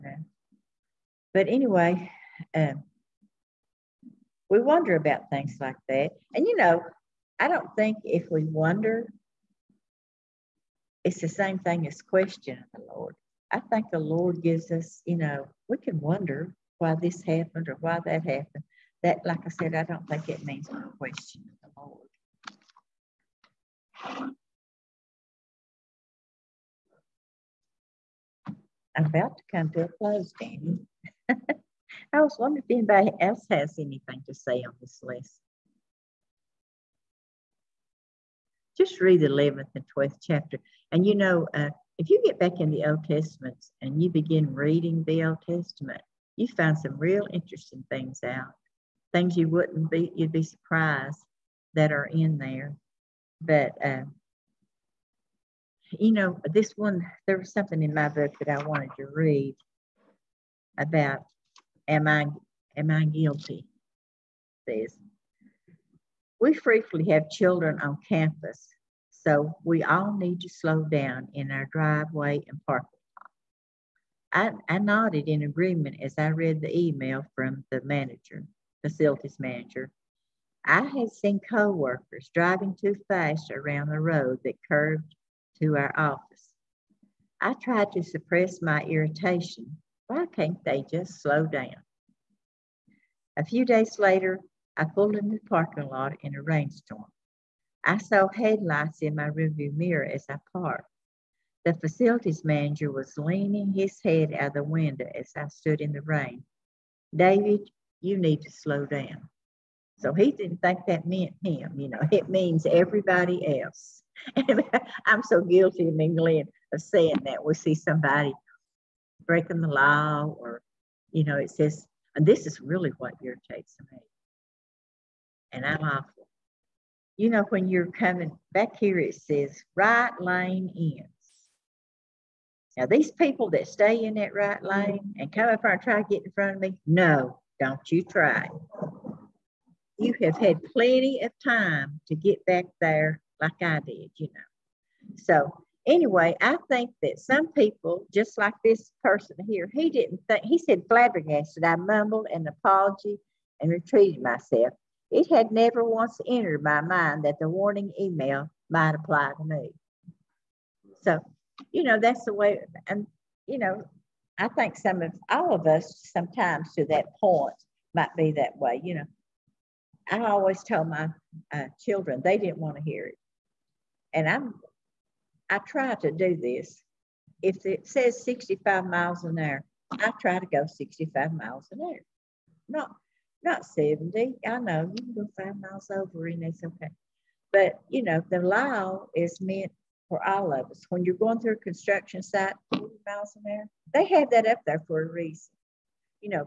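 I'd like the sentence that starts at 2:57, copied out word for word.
If it says 65 miles an hour, I try to go 65 miles an hour.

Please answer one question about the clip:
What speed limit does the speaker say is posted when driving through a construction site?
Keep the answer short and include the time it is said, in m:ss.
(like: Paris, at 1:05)
40 miles an hour, at 3:12.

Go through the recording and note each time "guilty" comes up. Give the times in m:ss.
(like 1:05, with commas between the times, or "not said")
1:03, 1:55.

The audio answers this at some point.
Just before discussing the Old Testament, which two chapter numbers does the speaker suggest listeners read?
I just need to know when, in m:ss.
0:39.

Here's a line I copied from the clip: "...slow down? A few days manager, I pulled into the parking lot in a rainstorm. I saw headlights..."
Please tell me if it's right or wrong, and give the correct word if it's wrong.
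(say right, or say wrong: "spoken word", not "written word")
wrong: "later", not "manager".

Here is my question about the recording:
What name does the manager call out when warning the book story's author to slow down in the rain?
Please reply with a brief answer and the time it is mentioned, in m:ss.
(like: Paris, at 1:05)
David, at 1:47.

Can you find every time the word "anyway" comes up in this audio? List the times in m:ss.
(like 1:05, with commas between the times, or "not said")
0:01, 2:25.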